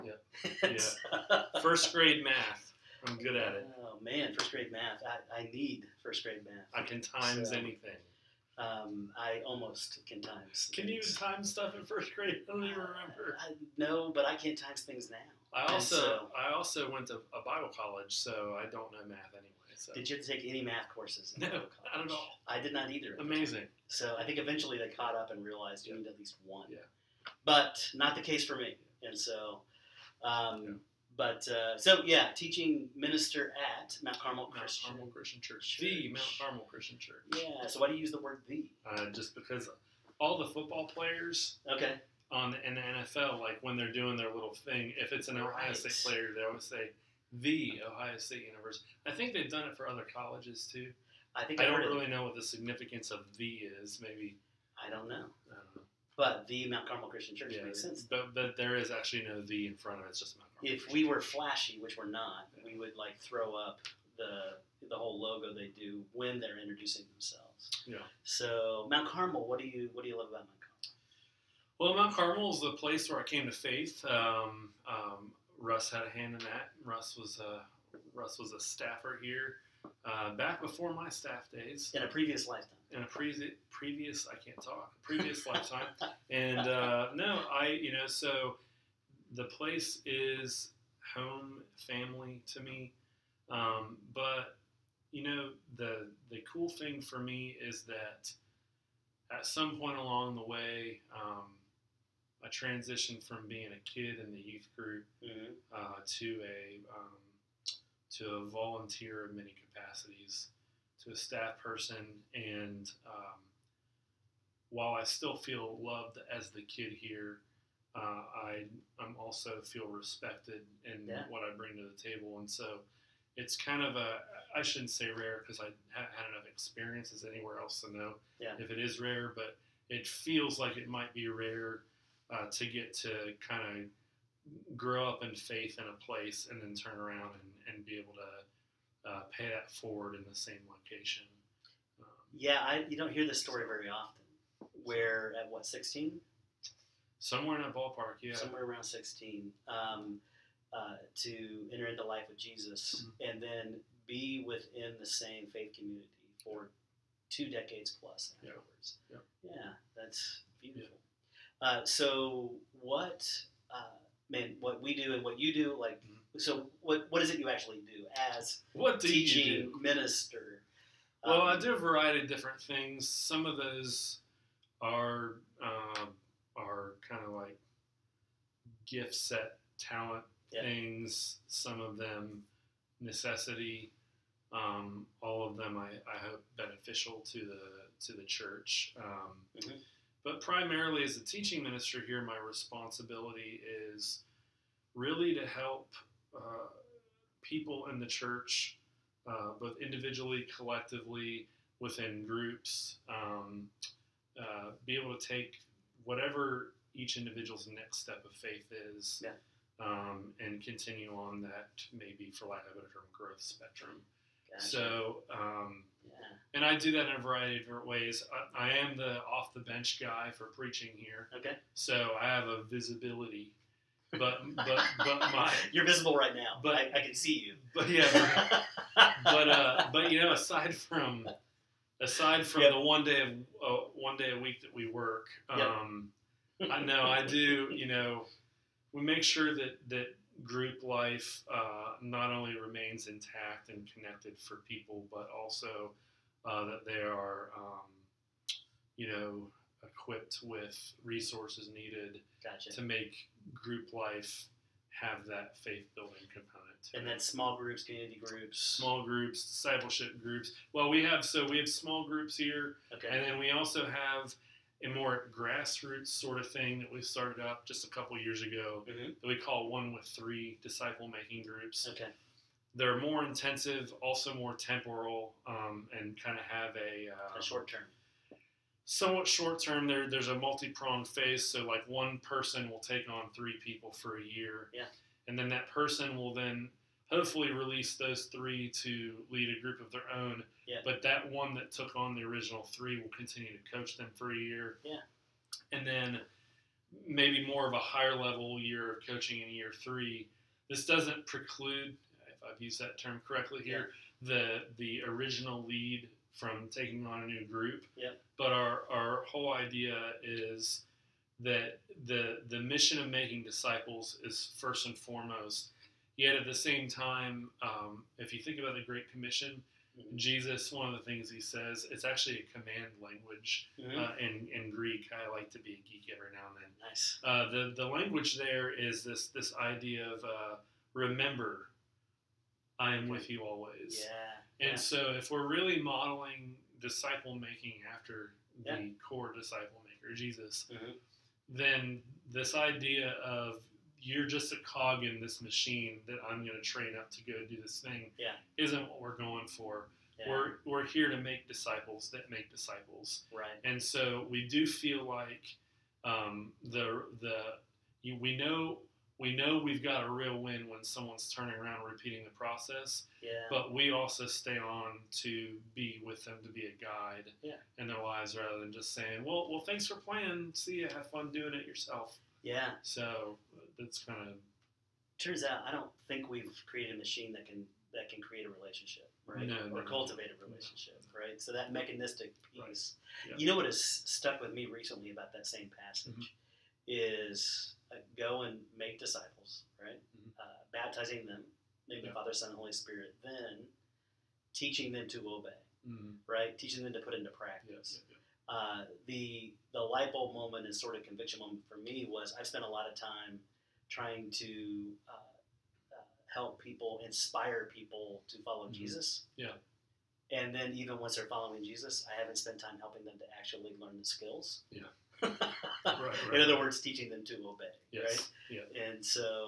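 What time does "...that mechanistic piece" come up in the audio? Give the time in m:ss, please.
6:21.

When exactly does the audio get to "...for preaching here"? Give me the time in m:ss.
3:40.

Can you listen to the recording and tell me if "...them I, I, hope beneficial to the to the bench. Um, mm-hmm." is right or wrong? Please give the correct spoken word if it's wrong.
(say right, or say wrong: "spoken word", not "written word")
wrong: "church", not "bench".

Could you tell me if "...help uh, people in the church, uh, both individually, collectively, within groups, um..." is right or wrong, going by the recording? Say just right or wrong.
right.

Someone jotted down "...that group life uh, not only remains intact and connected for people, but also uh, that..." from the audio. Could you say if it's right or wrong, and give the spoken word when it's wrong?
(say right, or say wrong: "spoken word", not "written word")
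right.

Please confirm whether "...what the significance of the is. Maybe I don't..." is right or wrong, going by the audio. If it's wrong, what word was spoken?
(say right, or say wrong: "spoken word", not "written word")
right.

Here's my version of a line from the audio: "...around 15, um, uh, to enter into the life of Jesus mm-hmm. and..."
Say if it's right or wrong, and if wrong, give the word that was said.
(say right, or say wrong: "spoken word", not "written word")
wrong: "16", not "15".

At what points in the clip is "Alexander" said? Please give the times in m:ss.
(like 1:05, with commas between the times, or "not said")
not said.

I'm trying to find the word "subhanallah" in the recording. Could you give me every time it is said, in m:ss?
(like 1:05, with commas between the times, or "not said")
not said.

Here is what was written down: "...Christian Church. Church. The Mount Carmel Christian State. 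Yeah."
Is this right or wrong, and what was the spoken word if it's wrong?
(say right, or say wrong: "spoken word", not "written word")
wrong: "Church", not "State".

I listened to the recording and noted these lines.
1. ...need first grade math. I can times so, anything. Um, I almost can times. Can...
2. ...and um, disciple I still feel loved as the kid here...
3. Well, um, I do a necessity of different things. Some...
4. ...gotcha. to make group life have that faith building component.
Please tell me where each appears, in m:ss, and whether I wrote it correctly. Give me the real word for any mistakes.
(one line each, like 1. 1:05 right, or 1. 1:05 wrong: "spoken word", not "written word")
1. 0:05 right
2. 1:52 wrong: "while", not "disciple"
3. 2:51 wrong: "variety", not "necessity"
4. 4:12 right.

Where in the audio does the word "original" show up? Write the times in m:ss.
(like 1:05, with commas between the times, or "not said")
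4:52, 5:05.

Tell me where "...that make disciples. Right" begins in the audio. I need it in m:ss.
5:52.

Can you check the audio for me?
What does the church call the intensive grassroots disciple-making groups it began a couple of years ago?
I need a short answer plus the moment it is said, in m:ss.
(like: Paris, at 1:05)
one with three, at 4:29.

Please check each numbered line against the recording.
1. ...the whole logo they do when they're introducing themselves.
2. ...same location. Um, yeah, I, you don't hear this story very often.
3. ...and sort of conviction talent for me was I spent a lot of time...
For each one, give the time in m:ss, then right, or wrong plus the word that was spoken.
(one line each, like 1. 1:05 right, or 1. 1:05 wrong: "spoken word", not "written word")
1. 1:04 right
2. 2:20 right
3. 6:40 wrong: "moment", not "talent".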